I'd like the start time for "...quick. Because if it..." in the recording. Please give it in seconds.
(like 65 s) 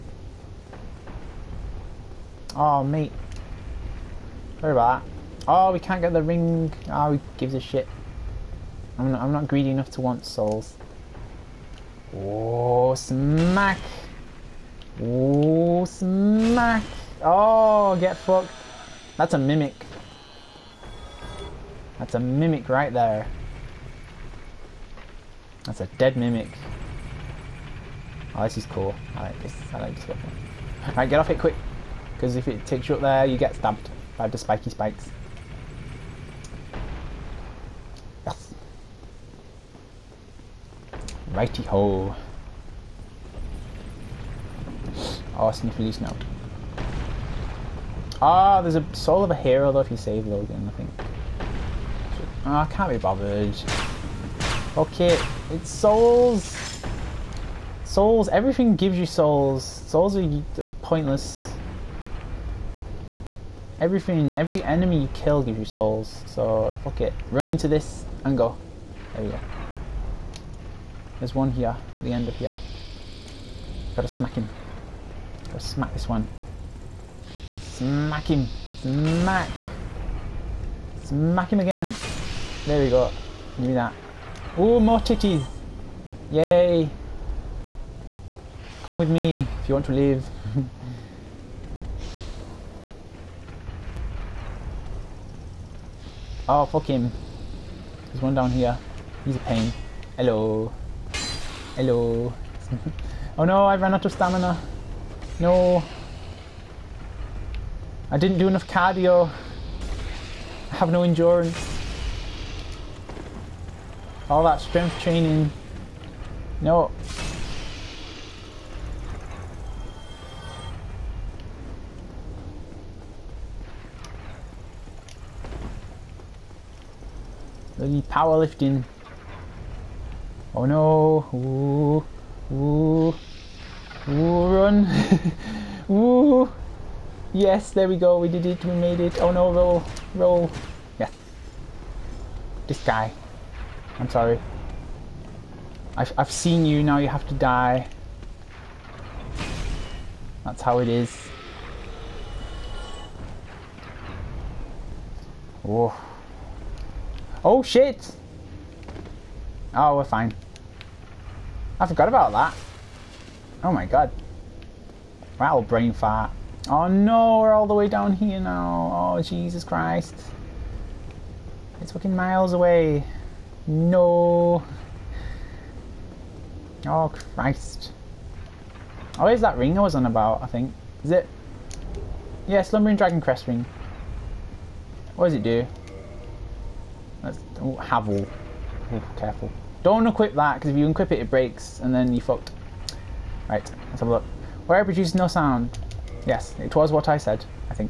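31 s.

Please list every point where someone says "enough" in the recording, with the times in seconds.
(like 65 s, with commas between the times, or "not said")
9 s, 108 s.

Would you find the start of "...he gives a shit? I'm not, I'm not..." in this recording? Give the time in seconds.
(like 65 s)
7 s.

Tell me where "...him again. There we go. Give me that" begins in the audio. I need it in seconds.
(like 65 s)
81 s.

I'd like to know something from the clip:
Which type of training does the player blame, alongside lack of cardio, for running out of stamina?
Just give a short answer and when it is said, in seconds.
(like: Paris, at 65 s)
Powerlifting, at 127 s.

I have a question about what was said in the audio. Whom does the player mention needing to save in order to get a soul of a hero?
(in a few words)
Logan.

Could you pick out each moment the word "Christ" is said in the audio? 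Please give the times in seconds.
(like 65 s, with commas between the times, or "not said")
169 s, 177 s.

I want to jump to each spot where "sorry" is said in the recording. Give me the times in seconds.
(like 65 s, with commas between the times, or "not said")
4 s, 144 s.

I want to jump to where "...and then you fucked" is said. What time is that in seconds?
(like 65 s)
191 s.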